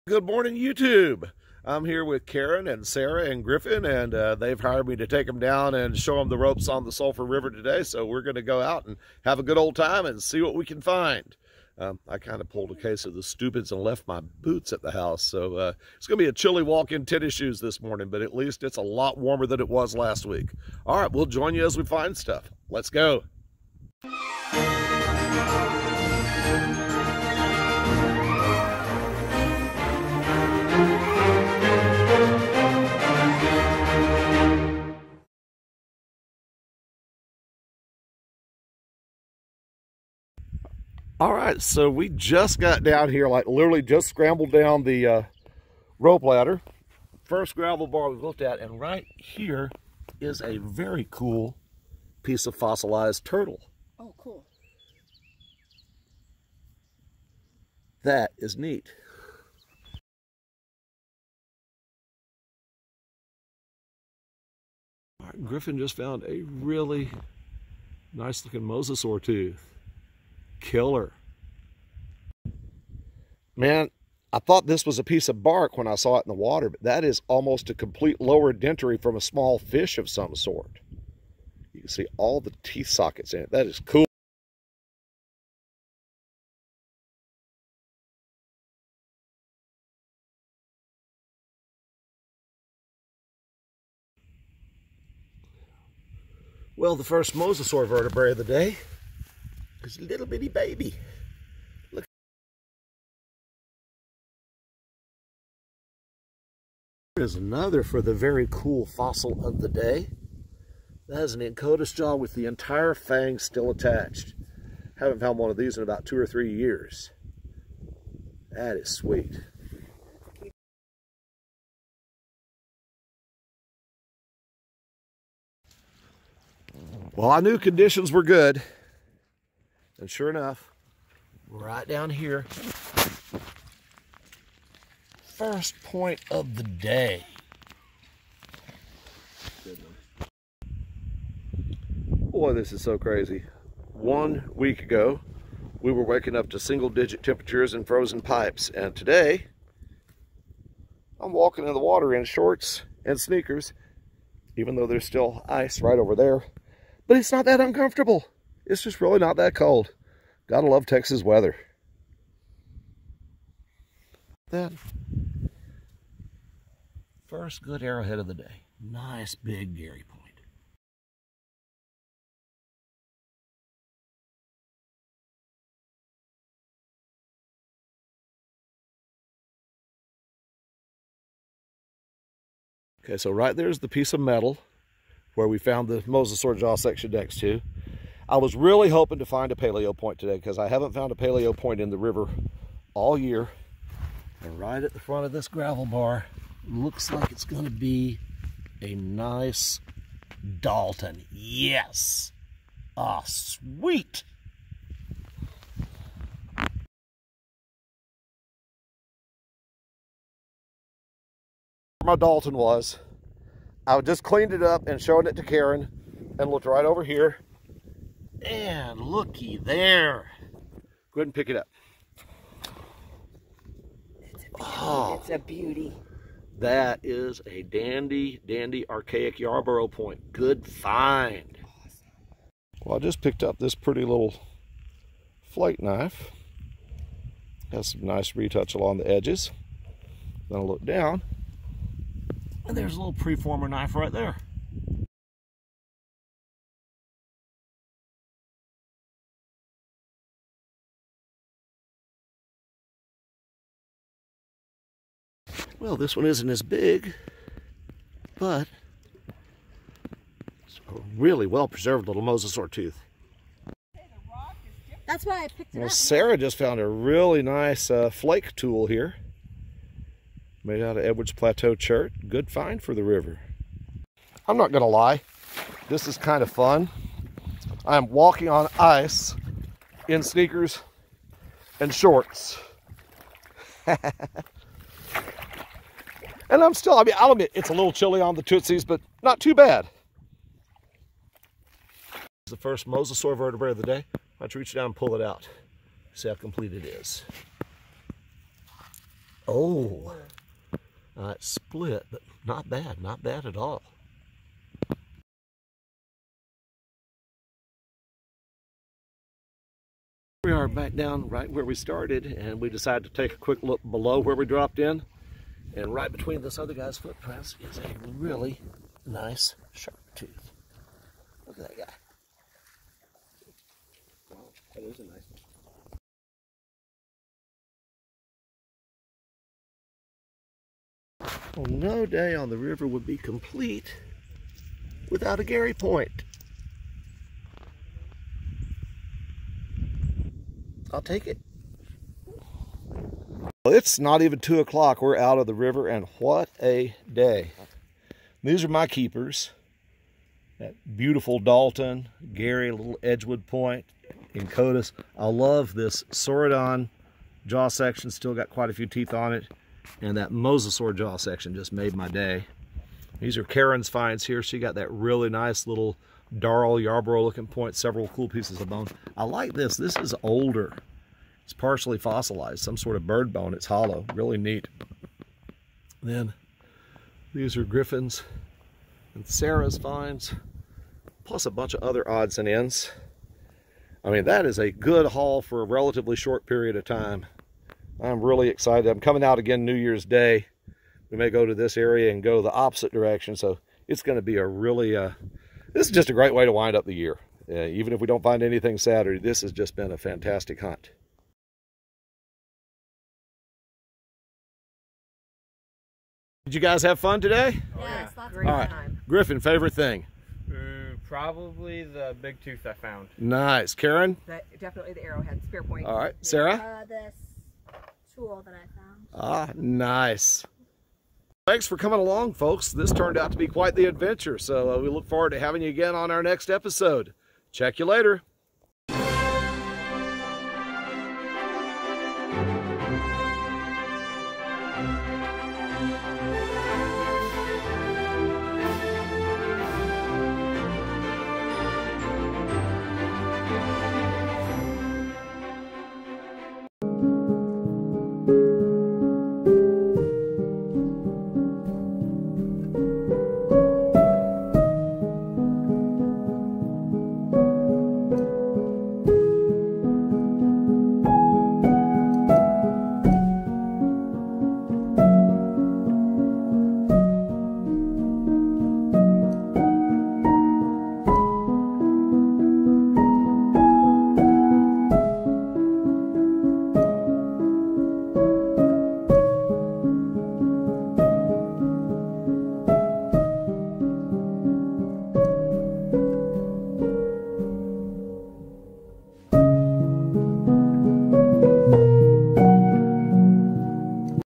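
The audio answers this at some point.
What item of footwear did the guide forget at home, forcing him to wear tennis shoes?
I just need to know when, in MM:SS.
00:14.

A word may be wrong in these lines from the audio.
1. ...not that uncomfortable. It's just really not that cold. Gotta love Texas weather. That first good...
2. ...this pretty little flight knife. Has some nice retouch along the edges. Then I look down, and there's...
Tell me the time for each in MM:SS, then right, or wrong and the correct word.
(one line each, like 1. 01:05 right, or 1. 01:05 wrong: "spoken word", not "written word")
1. 02:37 right
2. 03:53 right.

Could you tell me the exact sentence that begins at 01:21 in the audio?
You can see all the teeth sockets in it.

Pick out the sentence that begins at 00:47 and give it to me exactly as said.
First gravel bar we looked at, and right here is a very cool piece of fossilized turtle.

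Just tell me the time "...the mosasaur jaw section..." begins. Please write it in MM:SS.
03:05.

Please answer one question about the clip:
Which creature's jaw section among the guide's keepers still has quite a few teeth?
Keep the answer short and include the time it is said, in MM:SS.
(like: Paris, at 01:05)
Saurodon, at 05:56.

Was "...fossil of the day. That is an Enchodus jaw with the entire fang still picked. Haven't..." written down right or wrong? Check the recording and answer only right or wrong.
wrong.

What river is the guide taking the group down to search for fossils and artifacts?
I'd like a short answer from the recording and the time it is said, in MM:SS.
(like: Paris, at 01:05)
Sulphur River, at 00:06.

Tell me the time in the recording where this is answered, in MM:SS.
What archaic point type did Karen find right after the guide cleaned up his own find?
03:48.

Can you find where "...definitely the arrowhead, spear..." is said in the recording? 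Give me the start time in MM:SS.
06:54.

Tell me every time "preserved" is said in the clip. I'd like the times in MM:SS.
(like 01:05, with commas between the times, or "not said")
04:21.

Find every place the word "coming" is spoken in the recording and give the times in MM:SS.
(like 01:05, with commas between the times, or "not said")
06:29, 07:01.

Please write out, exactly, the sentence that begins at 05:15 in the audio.
And right between this other guy's footprints is a really nice sharp tooth.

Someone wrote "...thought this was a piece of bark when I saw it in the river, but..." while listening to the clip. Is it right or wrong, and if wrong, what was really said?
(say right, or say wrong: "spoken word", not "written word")
wrong: "water", not "river".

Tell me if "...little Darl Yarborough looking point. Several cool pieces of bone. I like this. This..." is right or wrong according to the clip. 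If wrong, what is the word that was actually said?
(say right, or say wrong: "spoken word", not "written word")
right.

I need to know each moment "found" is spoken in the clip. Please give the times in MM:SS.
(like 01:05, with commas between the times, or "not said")
01:05, 01:55, 03:05, 03:10, 04:26, 06:52, 06:58.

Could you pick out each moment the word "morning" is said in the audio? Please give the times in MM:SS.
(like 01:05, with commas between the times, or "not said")
00:00, 00:17.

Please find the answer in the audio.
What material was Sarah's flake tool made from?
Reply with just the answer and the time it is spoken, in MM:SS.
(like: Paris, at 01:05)
Edwards Plateau Chert, at 04:31.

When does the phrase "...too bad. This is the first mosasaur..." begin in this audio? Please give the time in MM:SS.
04:49.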